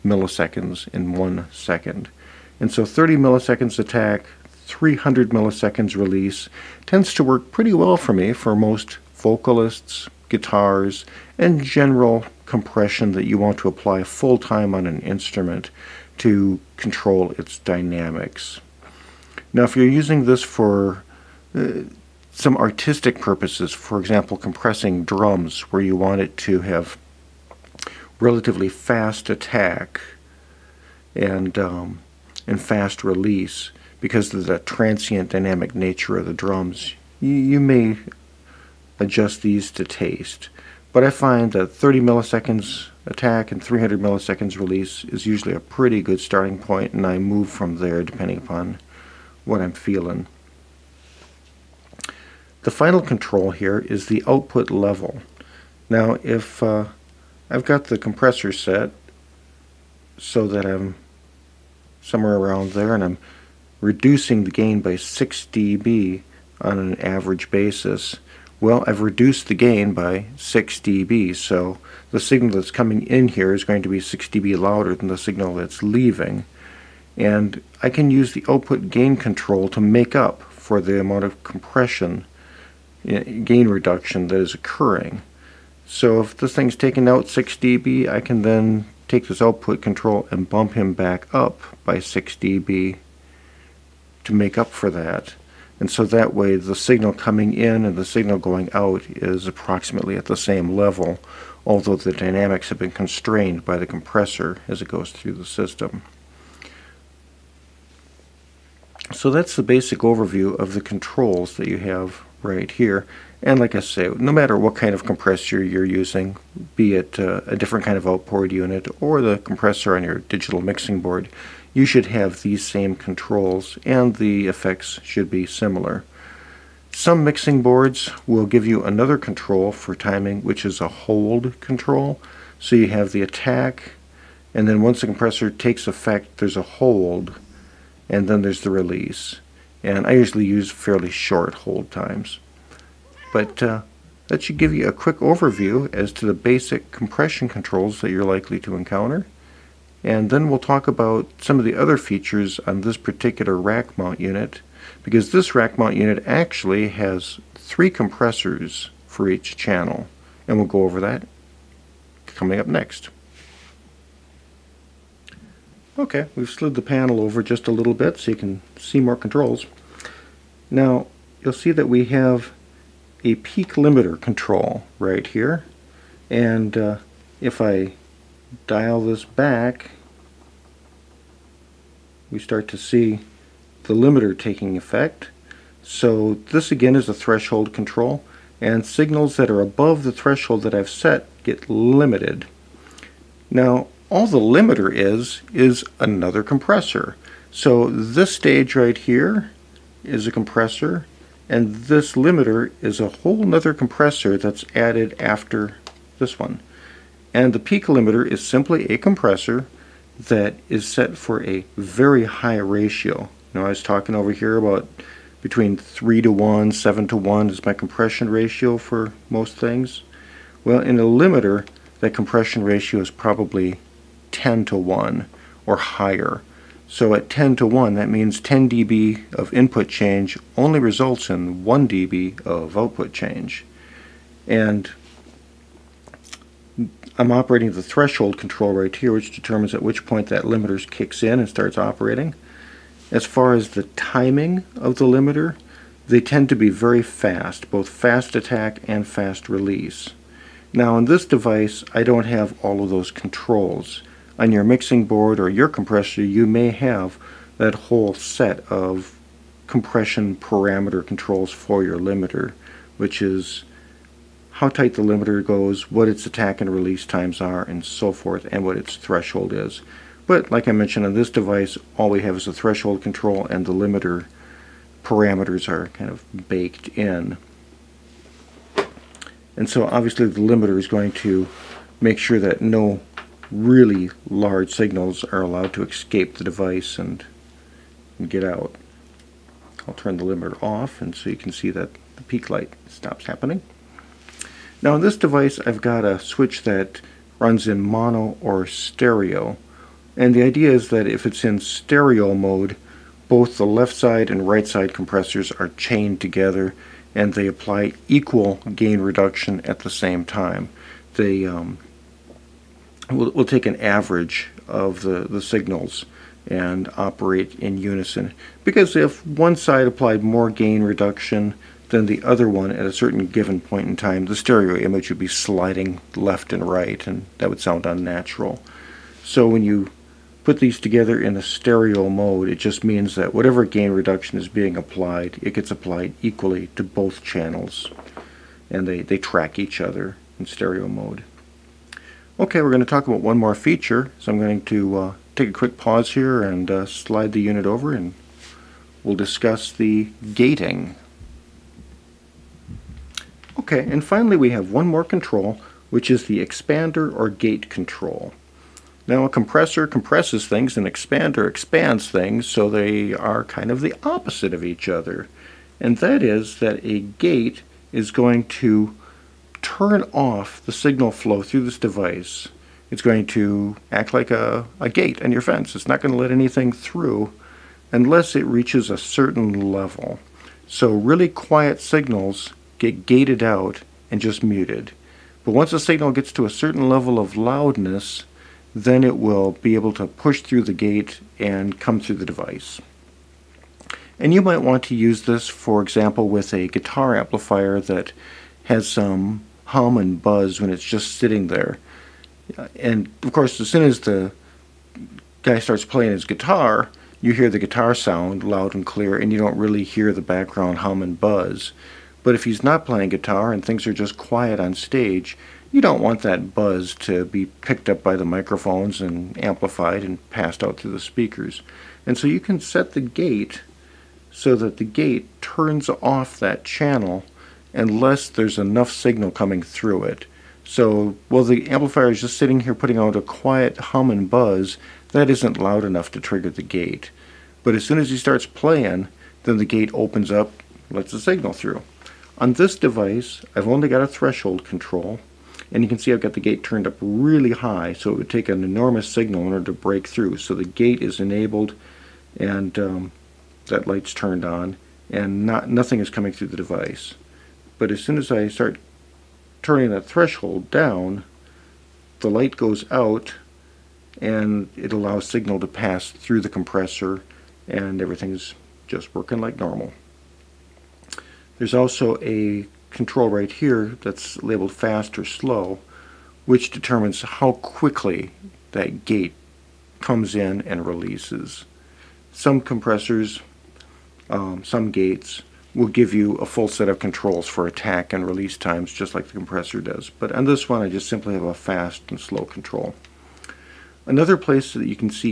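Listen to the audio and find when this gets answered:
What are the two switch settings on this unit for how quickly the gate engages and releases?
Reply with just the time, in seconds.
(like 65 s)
474 s.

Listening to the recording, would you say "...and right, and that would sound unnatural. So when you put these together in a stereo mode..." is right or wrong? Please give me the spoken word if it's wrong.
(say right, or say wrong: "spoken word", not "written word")
right.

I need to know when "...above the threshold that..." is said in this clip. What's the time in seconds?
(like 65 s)
189 s.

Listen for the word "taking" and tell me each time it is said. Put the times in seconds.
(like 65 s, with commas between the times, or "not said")
184 s.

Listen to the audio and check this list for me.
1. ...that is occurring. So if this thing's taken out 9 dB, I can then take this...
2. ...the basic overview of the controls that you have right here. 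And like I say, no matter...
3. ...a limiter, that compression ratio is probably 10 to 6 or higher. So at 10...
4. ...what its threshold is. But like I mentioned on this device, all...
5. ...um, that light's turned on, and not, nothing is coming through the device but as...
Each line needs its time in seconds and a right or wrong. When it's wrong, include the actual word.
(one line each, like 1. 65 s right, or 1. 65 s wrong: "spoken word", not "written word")
1. 84 s wrong: "6", not "9"
2. 109 s right
3. 220 s wrong: "1", not "6"
4. 268 s right
5. 452 s right.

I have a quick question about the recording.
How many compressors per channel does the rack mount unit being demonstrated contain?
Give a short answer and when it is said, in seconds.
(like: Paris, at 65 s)
3, at 157 s.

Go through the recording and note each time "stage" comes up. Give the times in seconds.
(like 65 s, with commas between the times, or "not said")
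198 s, 414 s.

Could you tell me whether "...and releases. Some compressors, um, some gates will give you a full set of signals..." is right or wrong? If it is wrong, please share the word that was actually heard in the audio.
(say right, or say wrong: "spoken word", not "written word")
wrong: "controls", not "signals".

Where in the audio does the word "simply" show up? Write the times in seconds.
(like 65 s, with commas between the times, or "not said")
208 s, 491 s.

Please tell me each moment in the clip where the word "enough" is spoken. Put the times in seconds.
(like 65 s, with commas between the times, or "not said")
428 s, 435 s.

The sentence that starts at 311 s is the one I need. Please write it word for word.
They um, we'll, we'll take an average of the, the signals and operate in unison.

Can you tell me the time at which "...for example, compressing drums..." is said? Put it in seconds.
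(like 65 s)
23 s.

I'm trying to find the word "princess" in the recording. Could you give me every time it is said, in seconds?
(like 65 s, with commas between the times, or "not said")
not said.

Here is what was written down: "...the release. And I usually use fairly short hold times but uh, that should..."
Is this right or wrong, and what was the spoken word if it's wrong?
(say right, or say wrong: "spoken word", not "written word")
right.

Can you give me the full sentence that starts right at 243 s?
As far as the timing of the limiter, they tend to be very fast, both fast attack and fast release.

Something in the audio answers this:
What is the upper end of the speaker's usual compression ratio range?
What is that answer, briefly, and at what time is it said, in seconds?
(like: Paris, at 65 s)
7 to 1, at 216 s.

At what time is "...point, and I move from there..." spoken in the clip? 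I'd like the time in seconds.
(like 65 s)
46 s.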